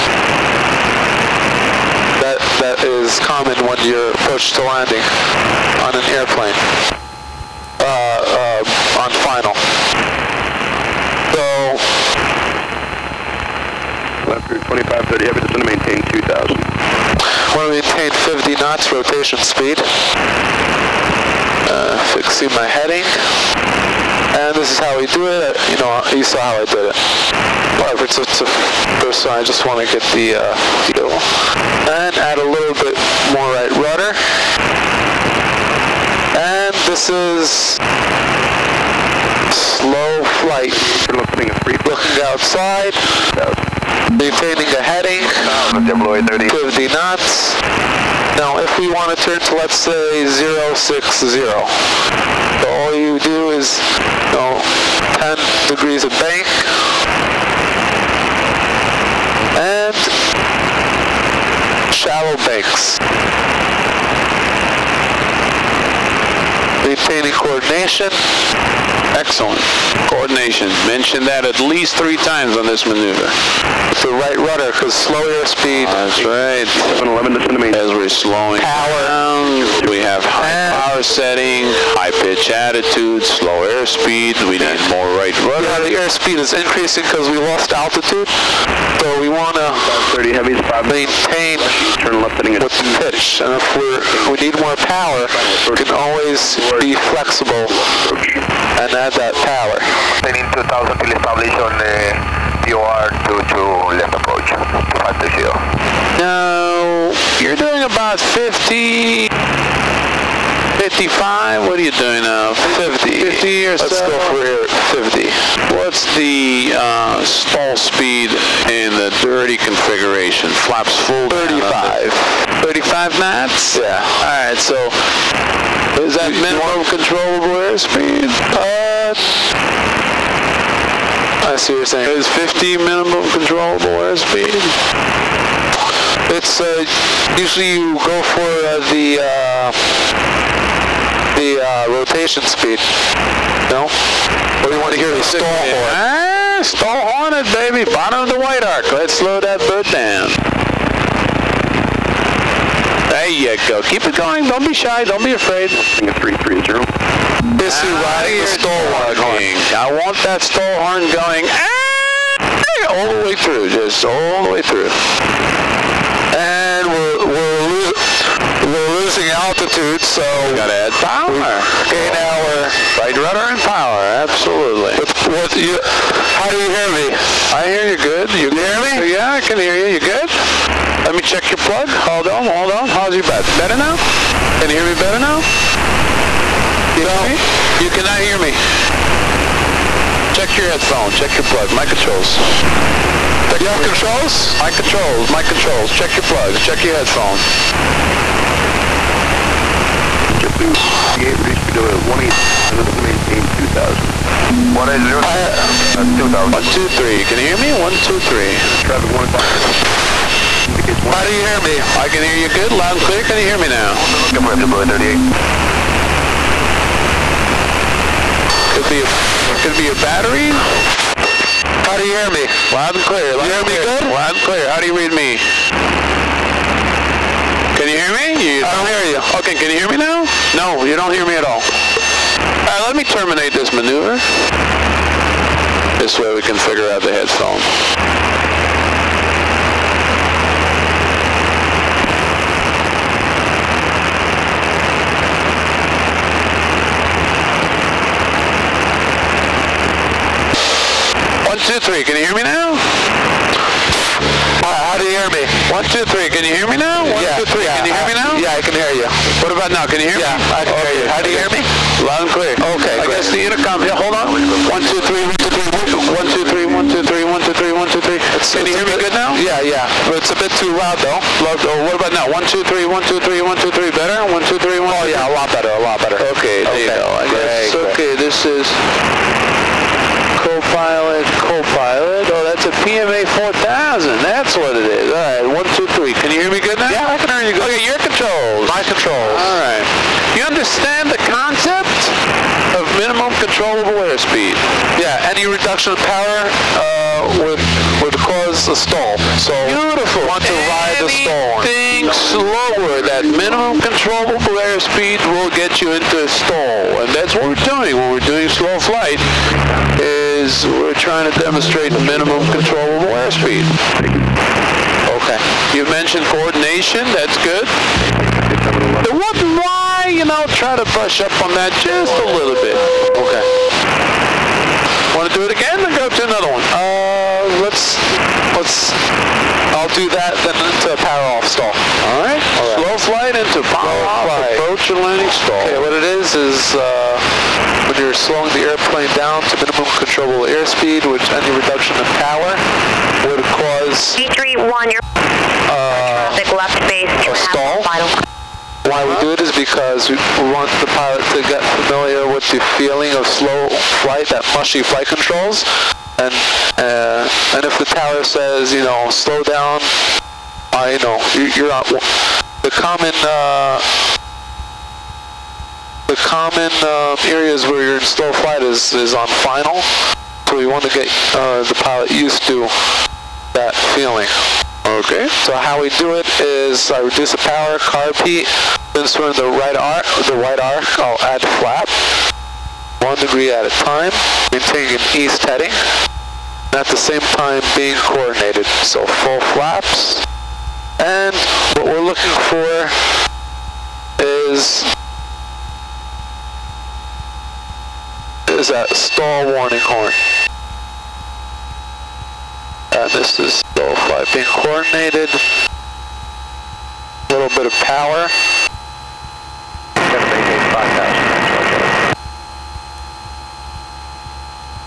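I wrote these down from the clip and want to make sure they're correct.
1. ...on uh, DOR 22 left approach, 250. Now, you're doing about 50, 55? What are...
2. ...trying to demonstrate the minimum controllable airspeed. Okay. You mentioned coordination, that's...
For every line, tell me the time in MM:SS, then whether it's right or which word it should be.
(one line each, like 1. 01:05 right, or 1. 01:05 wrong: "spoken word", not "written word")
1. 01:41 right
2. 05:10 right.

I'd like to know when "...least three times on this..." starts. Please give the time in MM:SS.
01:11.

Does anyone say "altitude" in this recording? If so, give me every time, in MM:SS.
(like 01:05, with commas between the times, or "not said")
01:27, 02:49.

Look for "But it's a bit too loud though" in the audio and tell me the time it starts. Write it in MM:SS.
04:30.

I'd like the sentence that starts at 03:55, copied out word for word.
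This way we can figure out the headphone.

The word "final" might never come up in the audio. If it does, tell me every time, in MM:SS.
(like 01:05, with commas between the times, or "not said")
00:09, 06:09.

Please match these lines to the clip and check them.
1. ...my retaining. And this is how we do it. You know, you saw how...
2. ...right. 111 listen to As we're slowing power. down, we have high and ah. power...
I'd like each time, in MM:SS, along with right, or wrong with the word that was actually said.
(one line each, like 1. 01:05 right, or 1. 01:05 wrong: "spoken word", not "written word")
1. 00:22 wrong: "heading", not "retaining"
2. 01:16 wrong: "711", not "111".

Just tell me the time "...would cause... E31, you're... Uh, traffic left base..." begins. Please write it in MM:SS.
05:43.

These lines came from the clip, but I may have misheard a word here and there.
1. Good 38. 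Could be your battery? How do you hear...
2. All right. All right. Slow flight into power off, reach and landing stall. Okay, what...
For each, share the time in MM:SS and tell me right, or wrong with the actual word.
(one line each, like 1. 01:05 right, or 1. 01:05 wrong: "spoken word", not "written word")
1. 03:34 right
2. 05:31 wrong: "approach", not "reach".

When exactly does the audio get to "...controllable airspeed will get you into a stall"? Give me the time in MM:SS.
05:03.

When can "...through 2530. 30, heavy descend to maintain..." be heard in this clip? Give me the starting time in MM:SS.
00:14.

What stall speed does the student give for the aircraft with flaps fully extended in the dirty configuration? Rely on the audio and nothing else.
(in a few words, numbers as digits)
35.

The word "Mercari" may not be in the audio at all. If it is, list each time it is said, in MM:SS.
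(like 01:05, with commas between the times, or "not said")
not said.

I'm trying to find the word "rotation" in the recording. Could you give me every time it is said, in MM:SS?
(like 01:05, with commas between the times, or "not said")
00:18, 02:21.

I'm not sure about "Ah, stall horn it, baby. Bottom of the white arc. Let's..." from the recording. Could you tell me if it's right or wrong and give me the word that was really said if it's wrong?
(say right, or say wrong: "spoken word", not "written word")
right.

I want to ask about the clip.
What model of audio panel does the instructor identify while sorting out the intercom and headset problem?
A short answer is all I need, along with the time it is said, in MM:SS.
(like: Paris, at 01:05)
PMA 4000, at 04:42.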